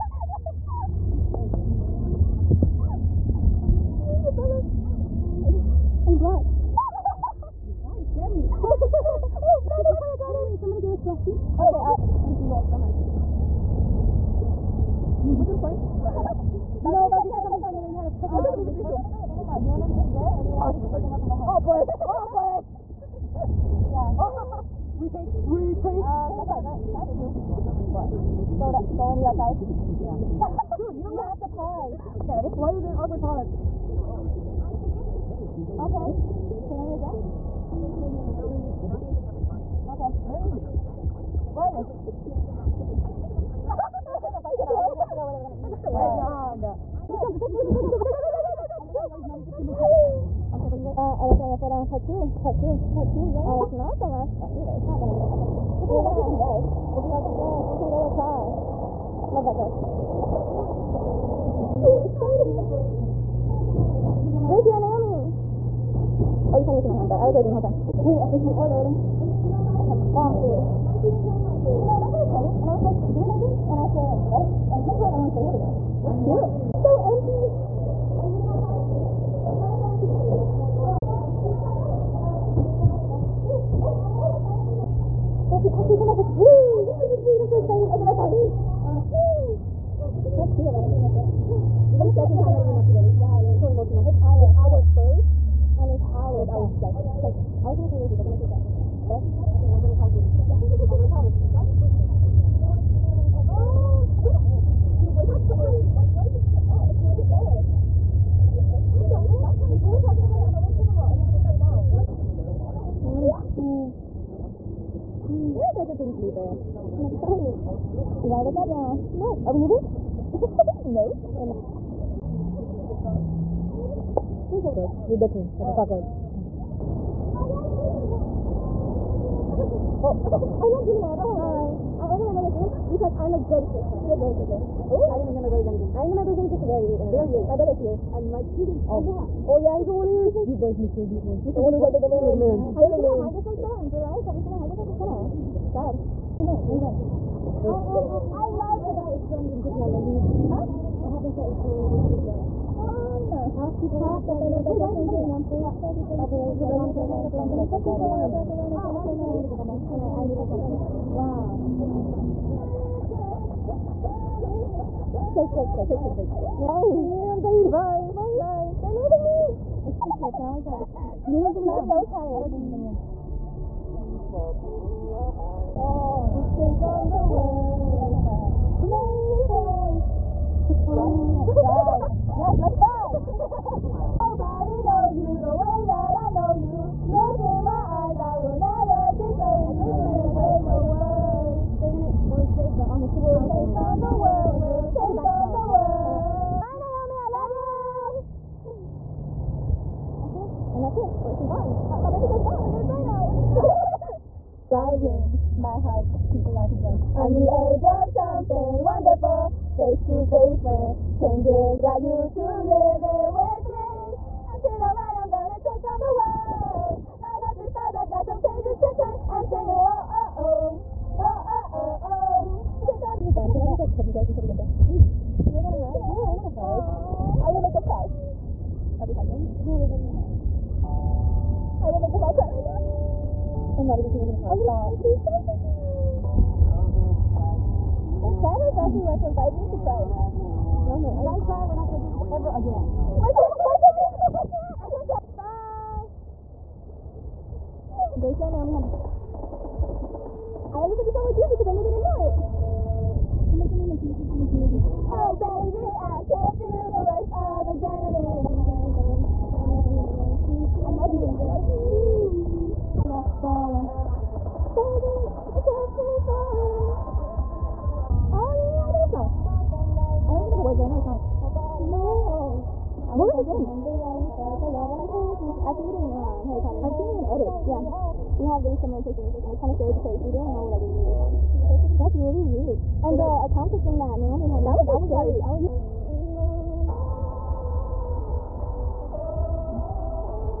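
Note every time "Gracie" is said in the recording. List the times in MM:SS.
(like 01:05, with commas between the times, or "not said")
01:04, 04:08.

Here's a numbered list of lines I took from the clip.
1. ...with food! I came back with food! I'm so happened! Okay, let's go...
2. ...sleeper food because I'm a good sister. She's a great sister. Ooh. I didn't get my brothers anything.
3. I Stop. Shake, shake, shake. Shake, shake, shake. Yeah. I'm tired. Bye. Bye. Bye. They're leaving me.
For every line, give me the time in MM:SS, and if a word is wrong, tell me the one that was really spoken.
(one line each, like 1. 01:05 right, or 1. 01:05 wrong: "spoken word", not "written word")
1. 01:26 wrong: "excited", not "happened"
2. 02:12 wrong: "brother", not "sleeper"
3. 02:40 wrong: "Wow", not "Stop".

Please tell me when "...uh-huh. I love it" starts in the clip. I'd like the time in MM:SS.
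02:27.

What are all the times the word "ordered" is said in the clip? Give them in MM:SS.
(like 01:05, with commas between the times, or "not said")
01:08, 02:12.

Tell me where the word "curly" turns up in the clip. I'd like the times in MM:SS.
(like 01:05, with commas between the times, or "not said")
01:12.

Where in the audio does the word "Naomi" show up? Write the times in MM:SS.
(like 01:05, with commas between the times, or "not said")
01:04, 04:08, 04:44.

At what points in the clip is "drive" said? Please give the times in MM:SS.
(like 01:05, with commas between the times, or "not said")
00:56, 03:02.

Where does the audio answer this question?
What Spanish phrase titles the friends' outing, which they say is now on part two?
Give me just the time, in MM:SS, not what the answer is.
00:51.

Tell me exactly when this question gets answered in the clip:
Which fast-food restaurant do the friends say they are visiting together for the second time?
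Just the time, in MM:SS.
01:32.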